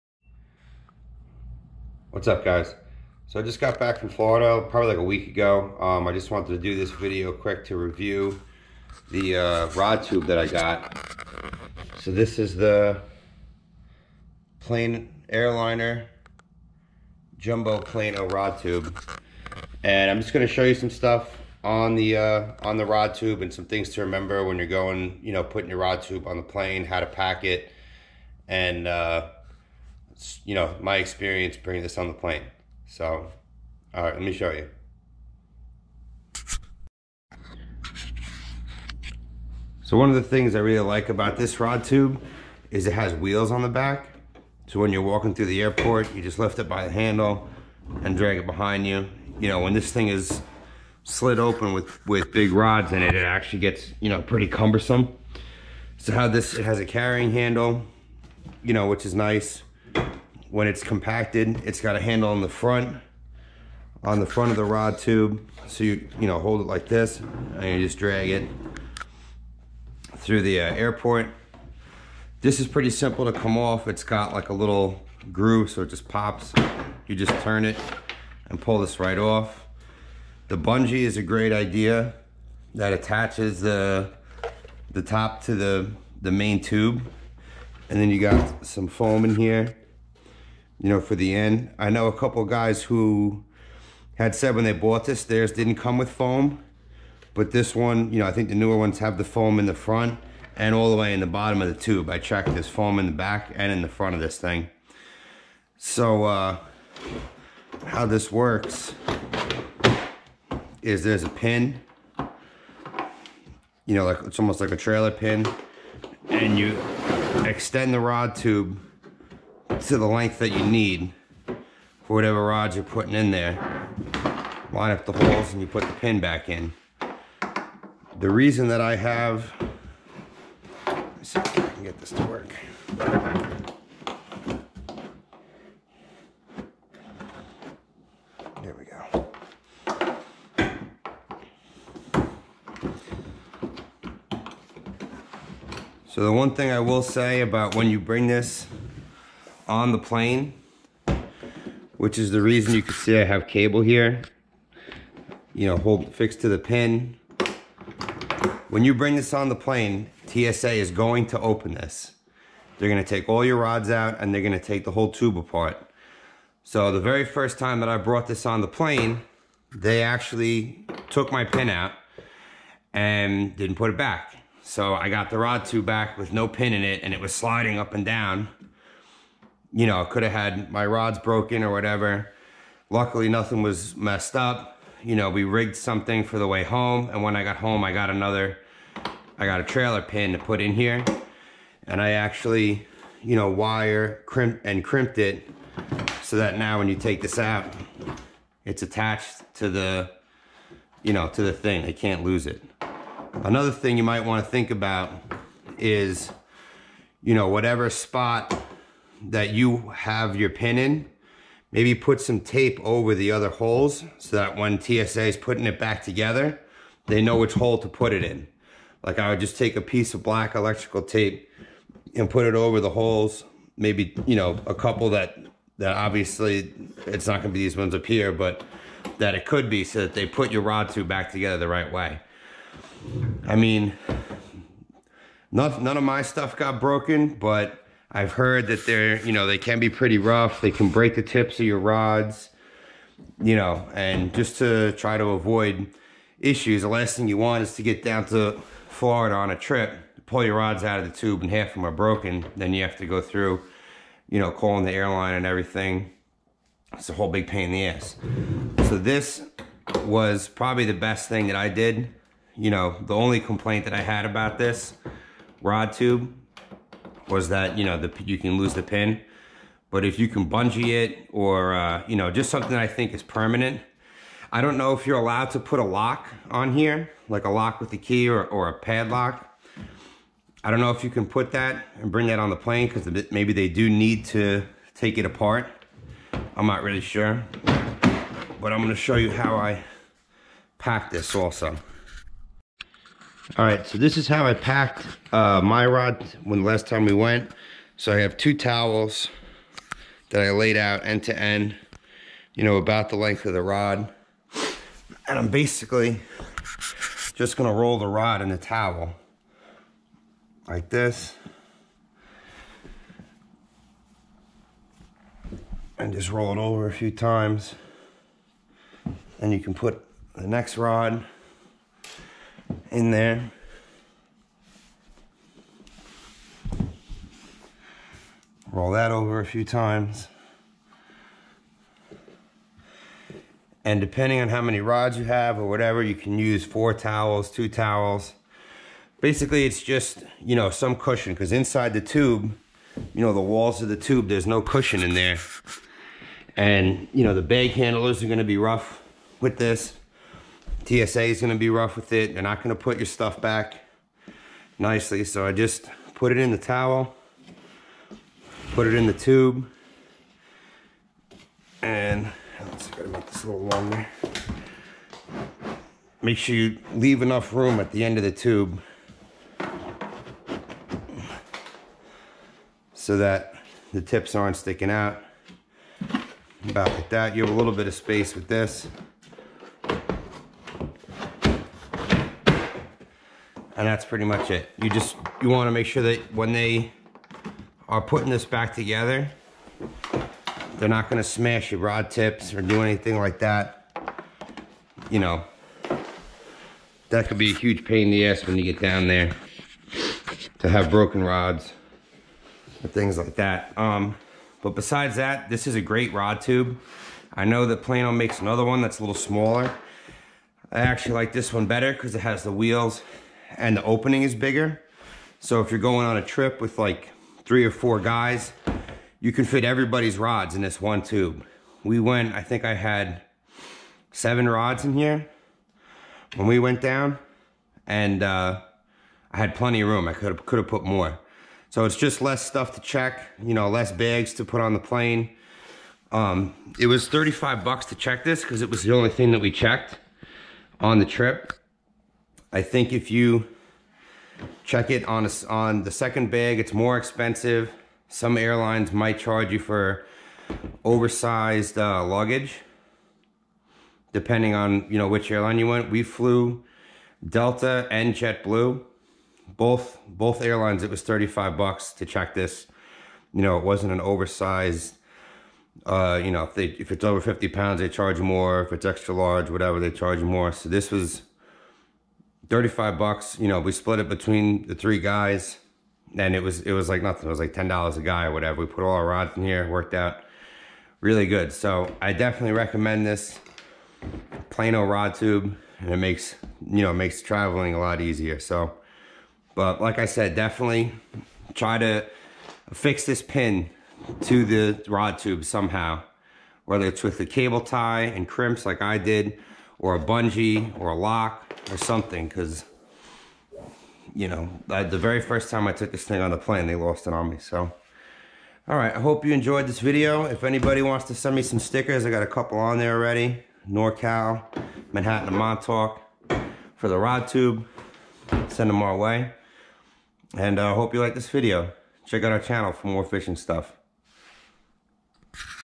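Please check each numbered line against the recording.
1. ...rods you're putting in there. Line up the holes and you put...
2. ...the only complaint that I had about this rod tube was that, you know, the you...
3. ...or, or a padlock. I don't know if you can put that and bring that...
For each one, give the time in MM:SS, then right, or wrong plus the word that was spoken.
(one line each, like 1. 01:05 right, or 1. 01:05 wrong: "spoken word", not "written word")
1. 02:02 right
2. 04:23 right
3. 04:38 right.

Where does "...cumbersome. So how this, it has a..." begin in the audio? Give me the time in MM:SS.
00:54.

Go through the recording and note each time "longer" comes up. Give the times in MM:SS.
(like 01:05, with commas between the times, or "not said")
06:03.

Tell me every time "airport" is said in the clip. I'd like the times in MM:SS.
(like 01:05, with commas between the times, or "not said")
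00:45, 01:10.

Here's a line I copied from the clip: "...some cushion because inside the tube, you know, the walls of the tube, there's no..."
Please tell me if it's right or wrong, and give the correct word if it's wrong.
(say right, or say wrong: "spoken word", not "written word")
right.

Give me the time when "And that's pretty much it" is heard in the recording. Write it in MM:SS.
06:23.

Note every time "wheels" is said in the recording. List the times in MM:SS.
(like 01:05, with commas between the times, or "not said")
00:43, 06:52.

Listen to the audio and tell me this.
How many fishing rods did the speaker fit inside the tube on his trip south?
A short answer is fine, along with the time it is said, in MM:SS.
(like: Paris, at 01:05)
7, at 07:04.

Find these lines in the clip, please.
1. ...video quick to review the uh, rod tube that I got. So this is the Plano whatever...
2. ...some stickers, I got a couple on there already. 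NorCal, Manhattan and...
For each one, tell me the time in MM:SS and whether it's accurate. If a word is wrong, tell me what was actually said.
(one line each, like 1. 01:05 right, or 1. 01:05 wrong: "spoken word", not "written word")
1. 00:06 wrong: "airliner", not "whatever"
2. 08:31 right.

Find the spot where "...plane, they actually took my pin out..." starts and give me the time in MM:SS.
02:48.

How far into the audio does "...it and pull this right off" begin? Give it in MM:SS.
01:17.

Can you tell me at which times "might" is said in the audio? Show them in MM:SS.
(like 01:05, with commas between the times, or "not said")
03:24, 07:28.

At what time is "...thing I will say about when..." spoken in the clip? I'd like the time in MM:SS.
02:26.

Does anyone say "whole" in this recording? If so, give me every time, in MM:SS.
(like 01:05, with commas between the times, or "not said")
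02:44, 04:17.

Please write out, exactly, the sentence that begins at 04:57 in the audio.
So I have two towels that I laid out end to end, you know, about the length of the rod.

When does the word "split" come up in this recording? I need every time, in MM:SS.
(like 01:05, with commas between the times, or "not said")
07:53.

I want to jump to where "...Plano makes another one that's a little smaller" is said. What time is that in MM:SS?
06:47.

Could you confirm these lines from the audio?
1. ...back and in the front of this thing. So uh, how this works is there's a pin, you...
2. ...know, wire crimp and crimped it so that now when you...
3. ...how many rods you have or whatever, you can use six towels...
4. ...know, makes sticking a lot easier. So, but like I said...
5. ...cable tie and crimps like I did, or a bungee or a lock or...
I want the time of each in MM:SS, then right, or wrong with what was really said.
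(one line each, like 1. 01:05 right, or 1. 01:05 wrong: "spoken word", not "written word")
1. 01:43 right
2. 03:13 right
3. 05:34 wrong: "four", not "six"
4. 08:06 wrong: "traveling", not "sticking"
5. 08:17 right.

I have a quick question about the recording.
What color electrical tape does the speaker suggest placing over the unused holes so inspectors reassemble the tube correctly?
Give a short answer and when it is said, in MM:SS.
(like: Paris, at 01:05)
black, at 03:40.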